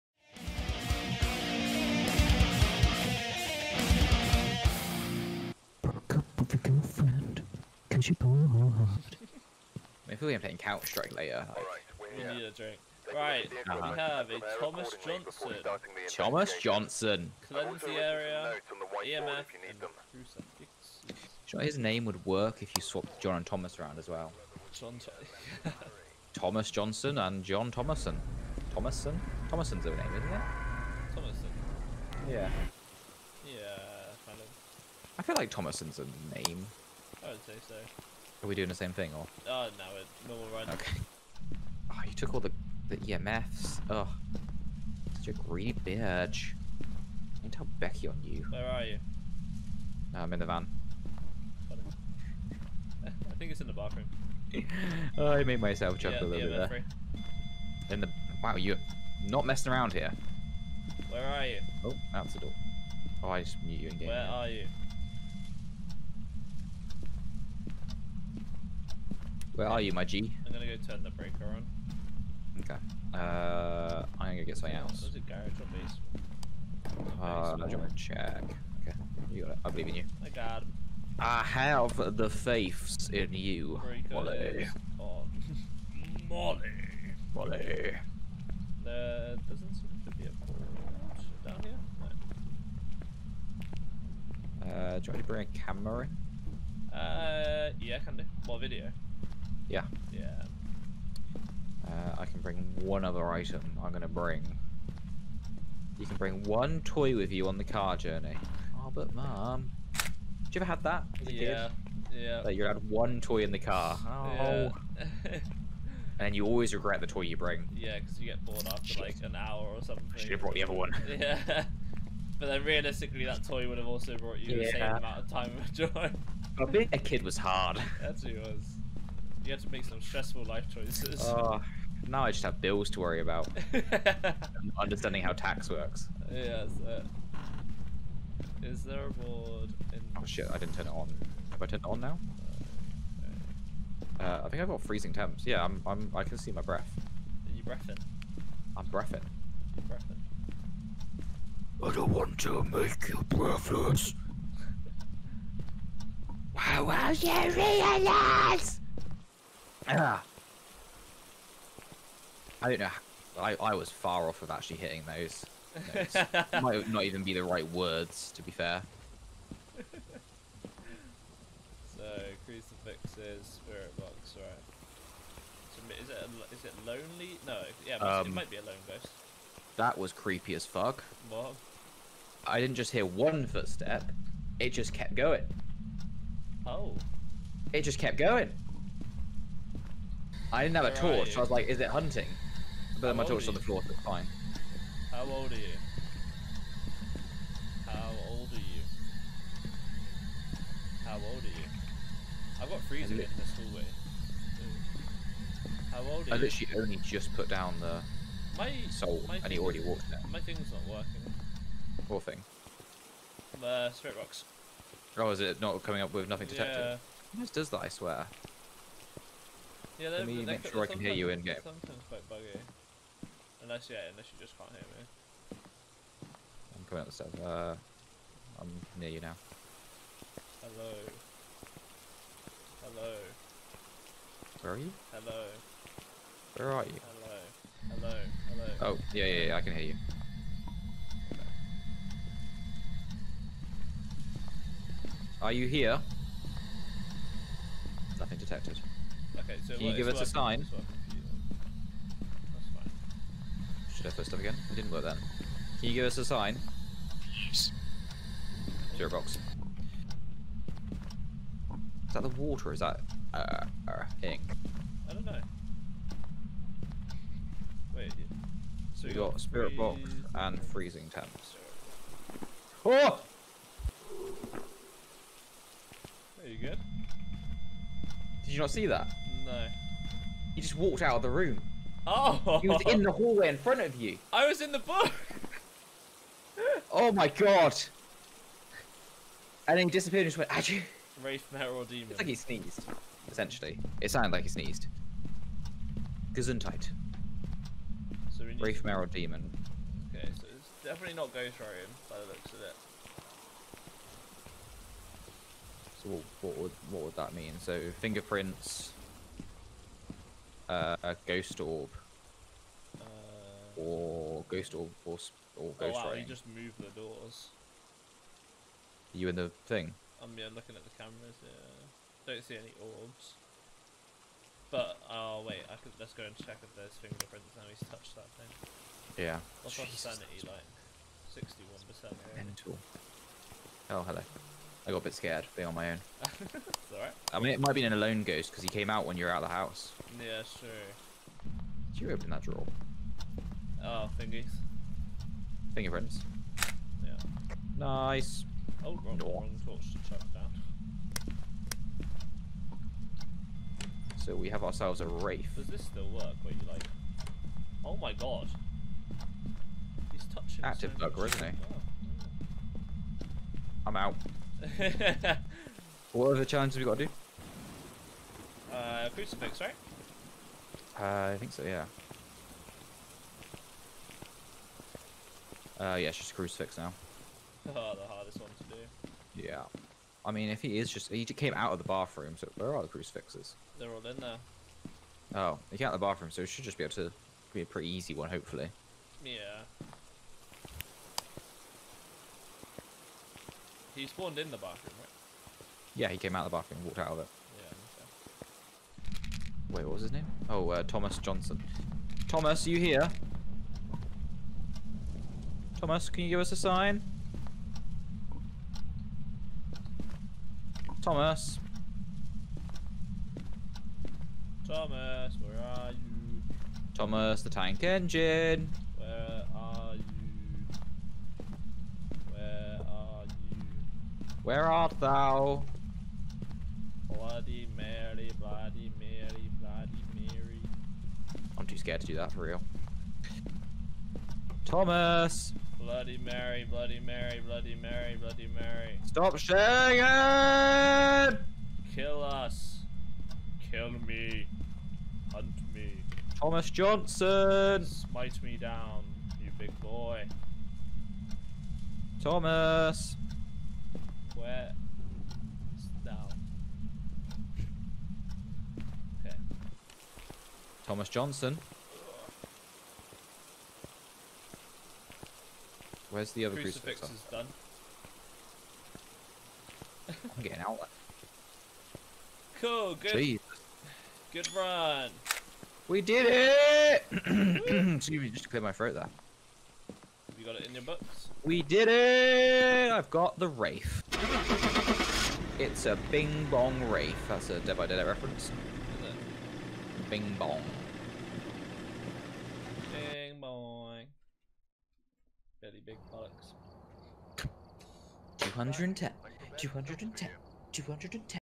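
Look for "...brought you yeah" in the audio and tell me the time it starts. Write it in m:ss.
2:04.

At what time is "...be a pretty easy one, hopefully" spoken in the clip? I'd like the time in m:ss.
6:27.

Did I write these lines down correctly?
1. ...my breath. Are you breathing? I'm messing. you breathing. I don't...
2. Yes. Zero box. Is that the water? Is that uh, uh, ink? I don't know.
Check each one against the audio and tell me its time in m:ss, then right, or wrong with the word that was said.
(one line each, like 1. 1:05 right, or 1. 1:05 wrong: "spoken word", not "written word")
1. 2:26 wrong: "breathing", not "messing"
2. 4:17 right.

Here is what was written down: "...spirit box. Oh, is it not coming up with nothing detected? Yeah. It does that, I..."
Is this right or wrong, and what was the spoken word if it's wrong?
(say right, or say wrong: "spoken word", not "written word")
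right.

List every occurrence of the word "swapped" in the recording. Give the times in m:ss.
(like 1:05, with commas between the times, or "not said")
0:22.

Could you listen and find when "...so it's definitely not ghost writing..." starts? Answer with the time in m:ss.
5:00.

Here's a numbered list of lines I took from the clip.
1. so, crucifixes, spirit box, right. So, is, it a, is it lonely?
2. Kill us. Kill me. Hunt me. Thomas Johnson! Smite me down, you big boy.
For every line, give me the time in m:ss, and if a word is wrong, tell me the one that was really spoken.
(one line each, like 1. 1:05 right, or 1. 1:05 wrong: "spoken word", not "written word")
1. 2:51 right
2. 7:21 right.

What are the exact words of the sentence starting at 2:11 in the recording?
Oh, now I just have bills to worry about.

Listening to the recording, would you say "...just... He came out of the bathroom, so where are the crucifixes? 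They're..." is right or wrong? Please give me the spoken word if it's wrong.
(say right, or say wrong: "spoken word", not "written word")
right.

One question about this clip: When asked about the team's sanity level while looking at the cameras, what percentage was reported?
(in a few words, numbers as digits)
61%.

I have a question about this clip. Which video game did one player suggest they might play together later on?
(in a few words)
Counter Strike.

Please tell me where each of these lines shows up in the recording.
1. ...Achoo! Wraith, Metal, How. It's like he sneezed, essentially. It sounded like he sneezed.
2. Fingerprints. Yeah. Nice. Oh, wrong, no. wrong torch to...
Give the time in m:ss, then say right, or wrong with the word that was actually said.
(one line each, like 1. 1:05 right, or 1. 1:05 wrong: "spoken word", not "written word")
1. 4:50 wrong: "Demon", not "How"
2. 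5:45 right.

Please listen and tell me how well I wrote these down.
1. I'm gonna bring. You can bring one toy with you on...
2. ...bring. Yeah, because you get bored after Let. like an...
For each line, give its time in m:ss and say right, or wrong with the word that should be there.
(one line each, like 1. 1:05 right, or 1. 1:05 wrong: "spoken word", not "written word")
1. 1:43 right
2. 1:57 wrong: "Shit", not "Let".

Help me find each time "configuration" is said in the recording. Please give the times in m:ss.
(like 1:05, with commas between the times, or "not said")
not said.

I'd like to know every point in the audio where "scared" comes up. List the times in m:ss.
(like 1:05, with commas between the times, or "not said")
5:35, 7:11.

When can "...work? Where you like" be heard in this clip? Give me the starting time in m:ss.
5:56.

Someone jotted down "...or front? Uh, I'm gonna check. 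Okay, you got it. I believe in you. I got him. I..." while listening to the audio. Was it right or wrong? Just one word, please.
wrong.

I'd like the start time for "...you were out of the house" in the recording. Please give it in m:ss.
5:39.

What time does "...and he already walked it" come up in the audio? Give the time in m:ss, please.
3:29.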